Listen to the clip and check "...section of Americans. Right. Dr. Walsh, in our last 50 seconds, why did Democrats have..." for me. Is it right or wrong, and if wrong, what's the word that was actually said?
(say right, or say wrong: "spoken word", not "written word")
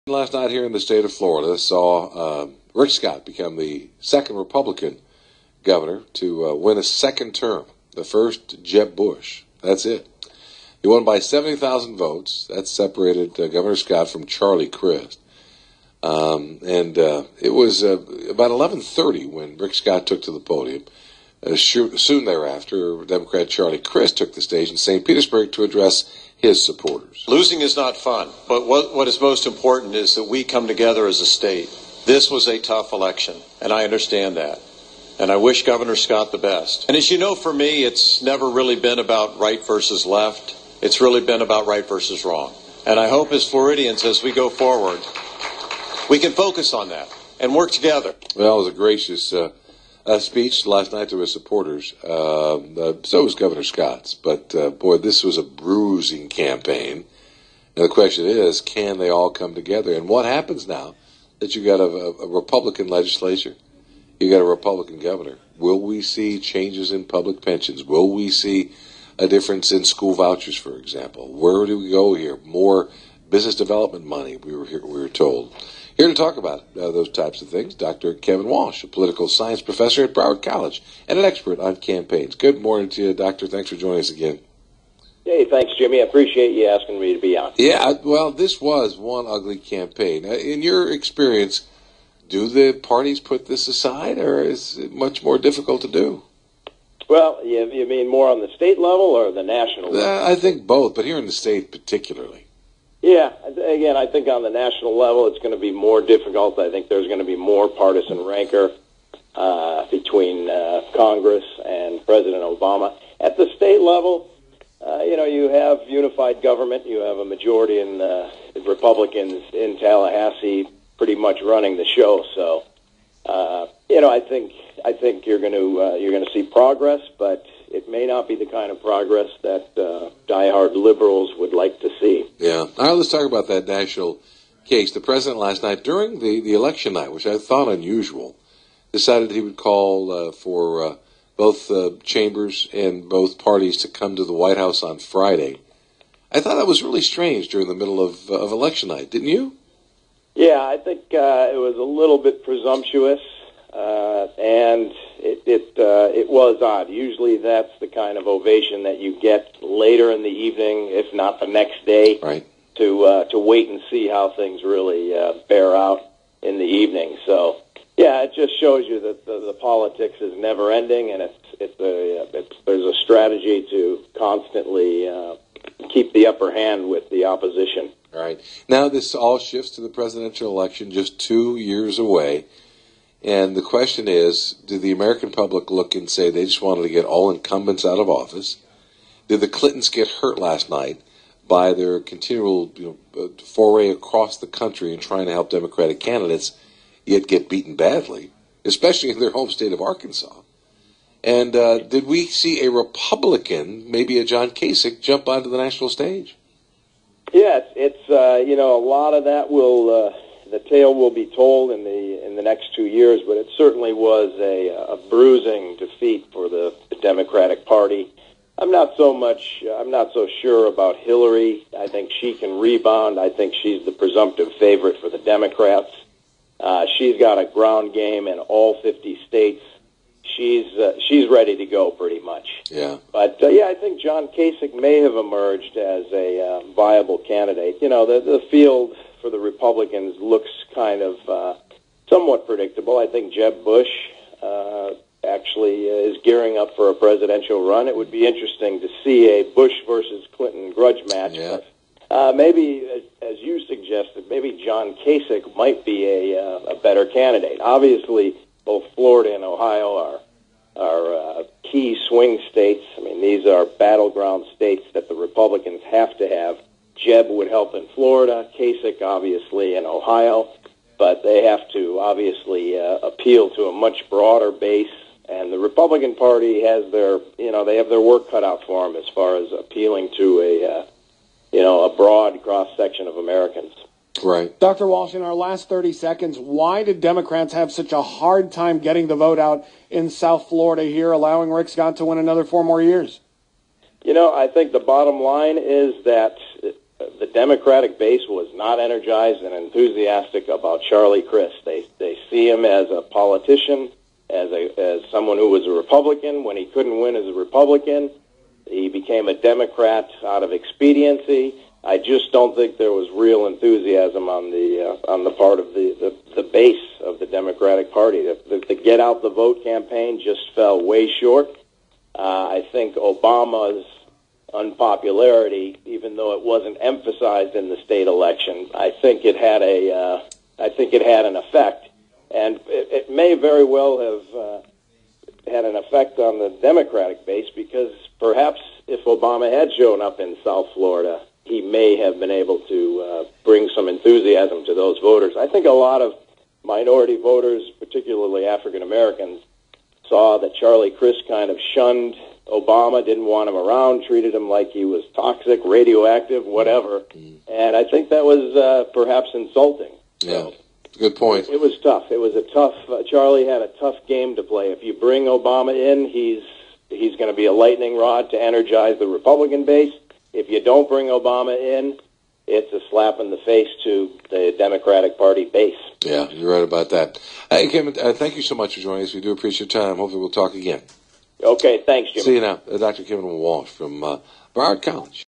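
wrong: "30", not "50".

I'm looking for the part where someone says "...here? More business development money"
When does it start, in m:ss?
1:12.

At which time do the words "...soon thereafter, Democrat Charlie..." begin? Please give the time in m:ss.
0:21.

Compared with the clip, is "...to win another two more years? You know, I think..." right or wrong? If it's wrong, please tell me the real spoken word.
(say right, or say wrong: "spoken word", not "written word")
wrong: "four", not "two".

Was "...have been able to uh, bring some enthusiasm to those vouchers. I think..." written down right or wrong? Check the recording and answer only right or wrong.
wrong.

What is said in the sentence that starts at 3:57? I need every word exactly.
You know, the the field for the Republicans looks kind of uh, somewhat predictable.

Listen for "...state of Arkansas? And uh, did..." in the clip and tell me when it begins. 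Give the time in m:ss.
3:19.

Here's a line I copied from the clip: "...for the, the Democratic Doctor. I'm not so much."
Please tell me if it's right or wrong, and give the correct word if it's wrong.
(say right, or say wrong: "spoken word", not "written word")
wrong: "Party", not "Doctor".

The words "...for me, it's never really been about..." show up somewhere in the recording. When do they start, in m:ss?
0:37.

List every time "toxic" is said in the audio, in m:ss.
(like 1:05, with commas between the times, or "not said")
5:55.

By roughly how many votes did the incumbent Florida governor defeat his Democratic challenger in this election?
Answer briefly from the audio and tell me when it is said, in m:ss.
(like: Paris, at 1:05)
70,000, at 0:11.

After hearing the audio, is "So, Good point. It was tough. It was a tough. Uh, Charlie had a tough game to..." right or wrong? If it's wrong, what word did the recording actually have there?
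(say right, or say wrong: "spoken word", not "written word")
right.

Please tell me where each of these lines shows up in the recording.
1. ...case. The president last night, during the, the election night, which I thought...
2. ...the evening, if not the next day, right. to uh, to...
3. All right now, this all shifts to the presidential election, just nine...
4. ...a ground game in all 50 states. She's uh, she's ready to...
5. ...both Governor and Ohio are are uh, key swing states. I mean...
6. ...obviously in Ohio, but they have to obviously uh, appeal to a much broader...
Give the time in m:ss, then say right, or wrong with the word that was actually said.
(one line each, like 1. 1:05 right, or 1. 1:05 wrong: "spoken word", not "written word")
1. 2:14 right
2. 2:40 right
3. 2:58 wrong: "two", not "nine"
4. 3:47 right
5. 4:18 wrong: "Florida", not "Governor"
6. 4:29 right.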